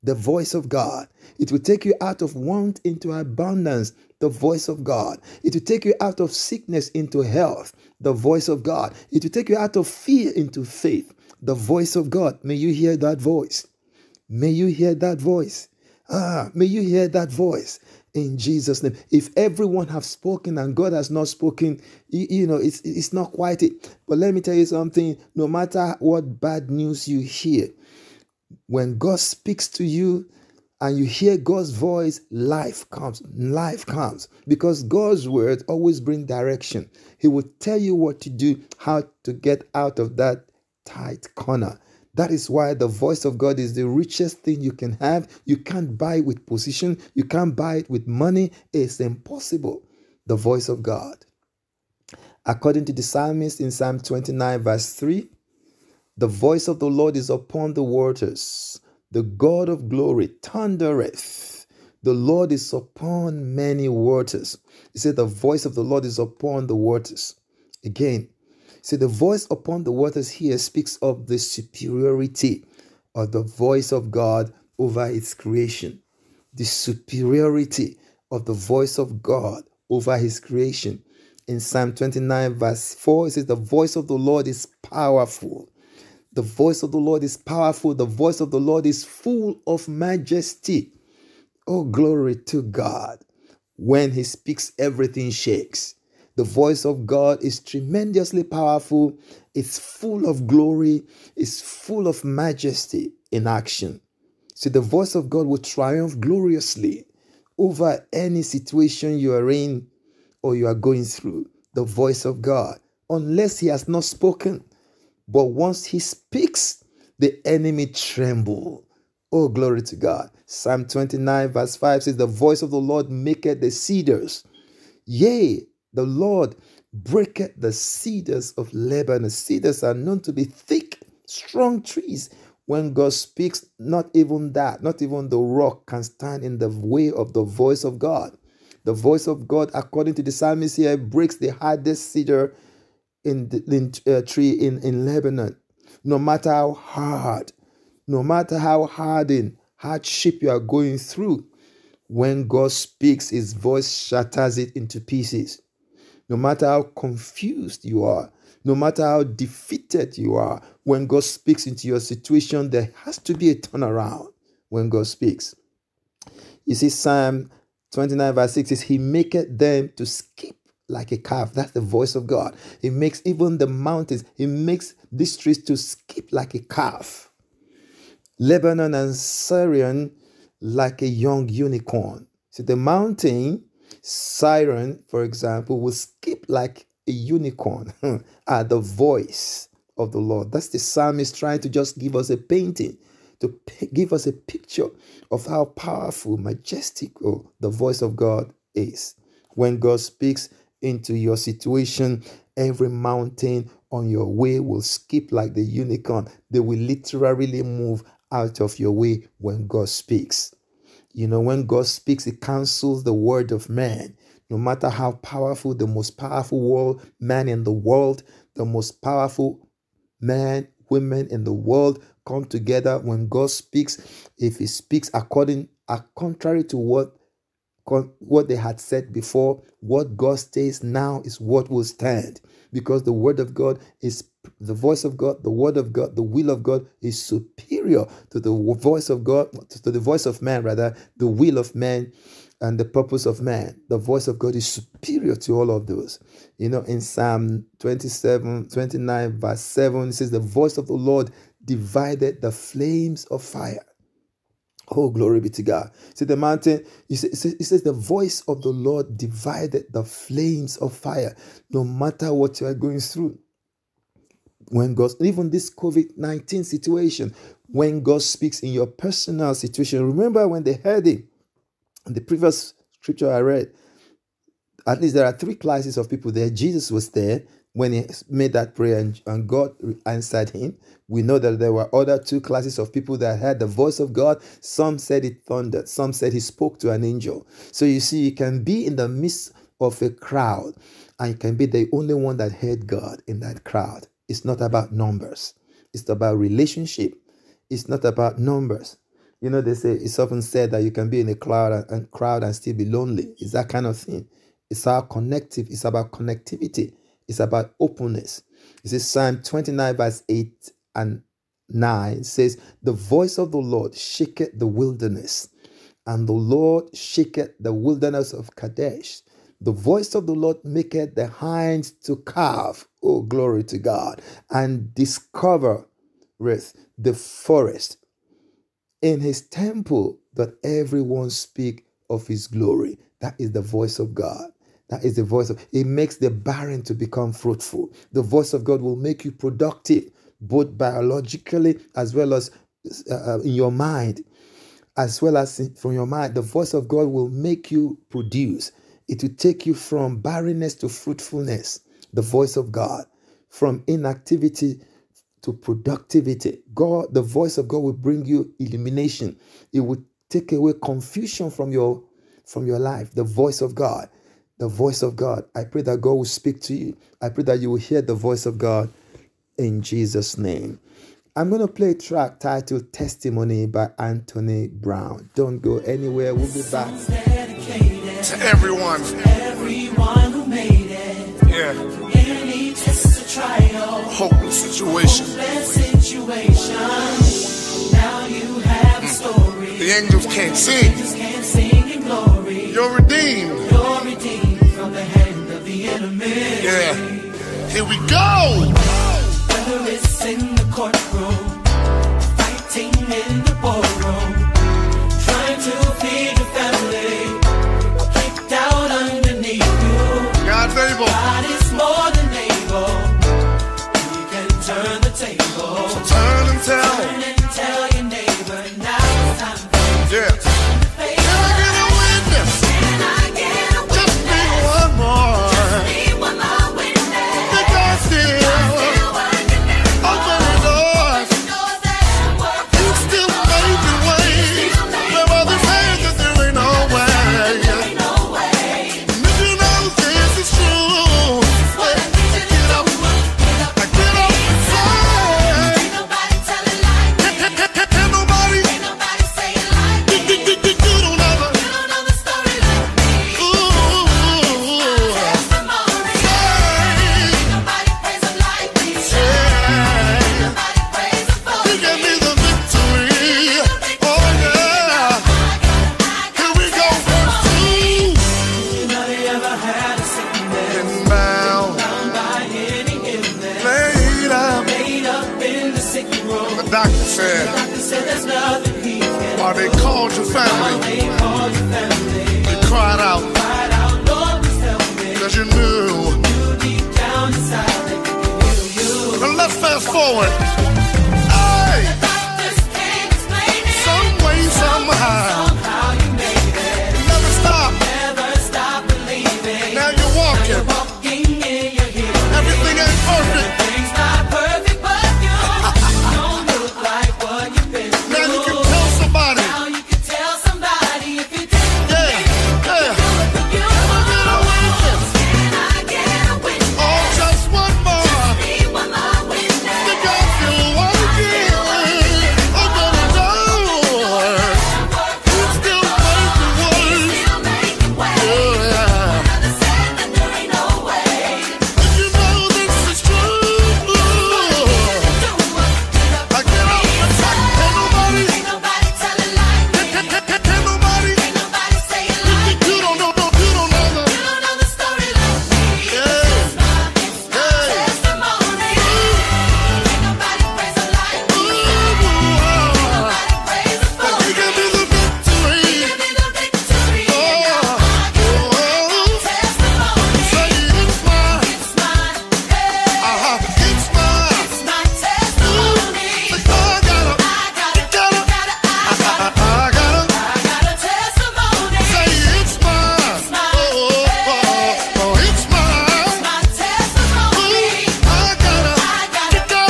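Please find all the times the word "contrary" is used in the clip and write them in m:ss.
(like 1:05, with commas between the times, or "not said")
3:46.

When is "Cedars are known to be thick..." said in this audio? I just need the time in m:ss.
2:09.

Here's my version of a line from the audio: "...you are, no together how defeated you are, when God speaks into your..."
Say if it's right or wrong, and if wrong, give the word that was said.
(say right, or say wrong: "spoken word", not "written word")
wrong: "matter", not "together".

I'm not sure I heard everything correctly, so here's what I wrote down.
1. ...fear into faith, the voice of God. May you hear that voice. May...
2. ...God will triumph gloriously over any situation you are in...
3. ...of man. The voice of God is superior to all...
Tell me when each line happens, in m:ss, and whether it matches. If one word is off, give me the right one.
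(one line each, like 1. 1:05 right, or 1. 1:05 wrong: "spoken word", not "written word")
1. 0:09 right
2. 1:45 right
3. 4:03 right.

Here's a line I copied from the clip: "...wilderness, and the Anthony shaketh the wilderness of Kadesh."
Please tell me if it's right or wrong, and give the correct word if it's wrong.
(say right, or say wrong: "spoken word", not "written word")
wrong: "Lord", not "Anthony".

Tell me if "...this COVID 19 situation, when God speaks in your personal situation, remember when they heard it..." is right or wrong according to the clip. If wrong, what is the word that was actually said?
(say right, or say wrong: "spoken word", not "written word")
right.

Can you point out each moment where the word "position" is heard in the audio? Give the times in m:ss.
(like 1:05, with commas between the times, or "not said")
0:46.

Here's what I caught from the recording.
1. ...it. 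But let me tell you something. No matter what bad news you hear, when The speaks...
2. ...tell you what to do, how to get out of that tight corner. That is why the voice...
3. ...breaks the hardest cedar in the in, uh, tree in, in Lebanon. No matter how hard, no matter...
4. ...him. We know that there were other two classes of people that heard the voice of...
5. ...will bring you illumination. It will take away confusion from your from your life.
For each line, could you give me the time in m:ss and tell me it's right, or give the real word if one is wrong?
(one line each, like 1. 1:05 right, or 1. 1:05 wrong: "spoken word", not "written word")
1. 0:23 wrong: "God", not "The"
2. 0:37 right
3. 2:20 right
4. 4:40 right
5. 5:57 right.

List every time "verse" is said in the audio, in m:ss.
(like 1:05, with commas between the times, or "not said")
0:54, 1:22, 2:01, 2:48, 4:09, 5:09.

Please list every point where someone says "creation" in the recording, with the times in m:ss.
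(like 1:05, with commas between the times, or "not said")
1:15, 1:20.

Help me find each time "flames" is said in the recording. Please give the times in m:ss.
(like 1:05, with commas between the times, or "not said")
4:12, 4:20.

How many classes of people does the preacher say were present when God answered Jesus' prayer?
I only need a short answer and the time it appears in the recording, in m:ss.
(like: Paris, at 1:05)
3, at 4:35.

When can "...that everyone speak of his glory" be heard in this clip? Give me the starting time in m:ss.
5:30.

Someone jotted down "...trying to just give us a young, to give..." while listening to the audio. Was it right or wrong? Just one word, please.
wrong.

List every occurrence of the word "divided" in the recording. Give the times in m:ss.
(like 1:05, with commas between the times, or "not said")
4:11, 4:19.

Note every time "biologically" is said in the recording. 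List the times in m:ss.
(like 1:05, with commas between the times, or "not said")
5:40.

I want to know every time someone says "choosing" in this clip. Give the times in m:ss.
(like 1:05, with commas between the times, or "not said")
not said.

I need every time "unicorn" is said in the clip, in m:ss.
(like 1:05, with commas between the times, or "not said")
3:01, 3:07, 3:25.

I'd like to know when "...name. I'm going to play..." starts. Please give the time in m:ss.
6:10.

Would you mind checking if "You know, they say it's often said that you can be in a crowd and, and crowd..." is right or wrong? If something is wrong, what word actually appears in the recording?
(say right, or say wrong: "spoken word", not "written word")
right.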